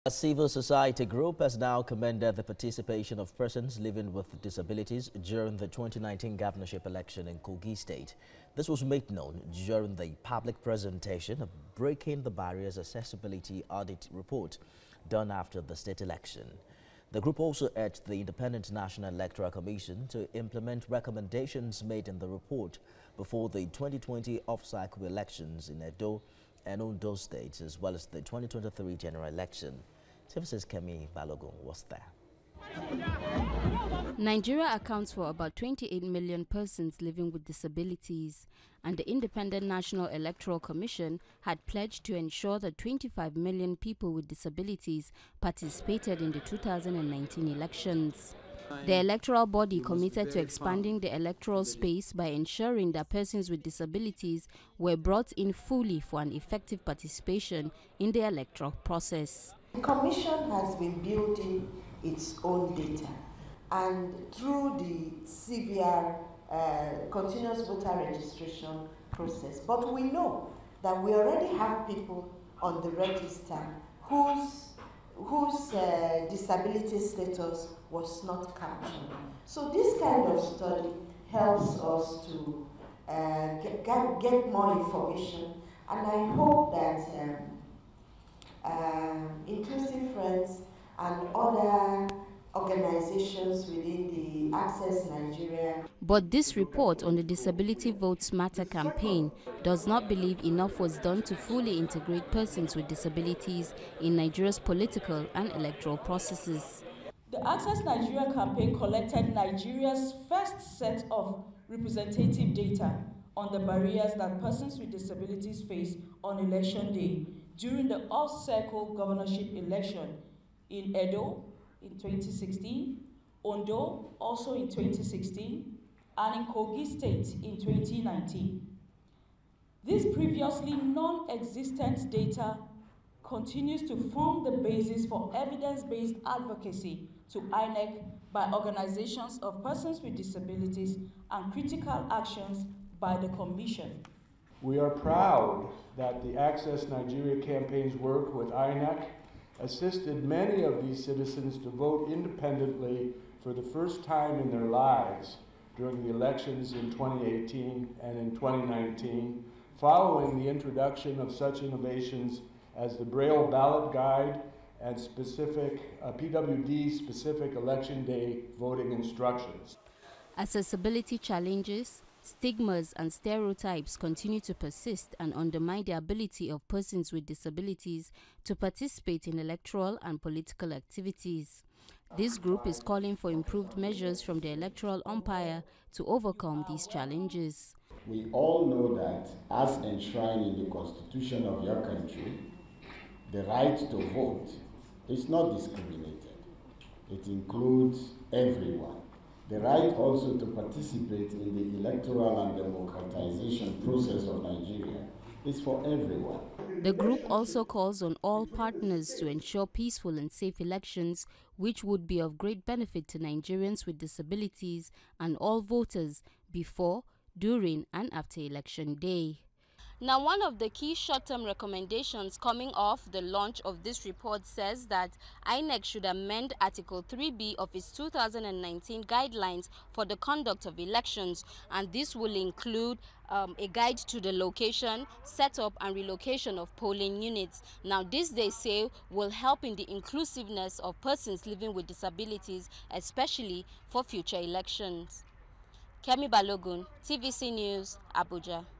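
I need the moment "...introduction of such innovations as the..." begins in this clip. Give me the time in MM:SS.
02:40.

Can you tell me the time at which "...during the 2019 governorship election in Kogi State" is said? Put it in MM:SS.
00:05.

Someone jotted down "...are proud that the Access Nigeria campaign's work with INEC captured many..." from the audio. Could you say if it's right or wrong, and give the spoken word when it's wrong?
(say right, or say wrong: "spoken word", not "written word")
wrong: "assisted", not "captured".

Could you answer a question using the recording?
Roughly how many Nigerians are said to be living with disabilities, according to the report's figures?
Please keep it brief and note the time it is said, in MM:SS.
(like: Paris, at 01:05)
28 million, at 00:35.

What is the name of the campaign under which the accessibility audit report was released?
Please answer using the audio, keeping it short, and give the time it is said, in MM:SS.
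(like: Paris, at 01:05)
Disability Votes Matter, at 01:37.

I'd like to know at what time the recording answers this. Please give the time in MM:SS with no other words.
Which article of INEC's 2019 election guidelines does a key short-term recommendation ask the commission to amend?
03:46.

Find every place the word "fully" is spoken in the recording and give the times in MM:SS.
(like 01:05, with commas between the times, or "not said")
00:55, 01:41.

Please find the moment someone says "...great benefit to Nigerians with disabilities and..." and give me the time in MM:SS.
03:32.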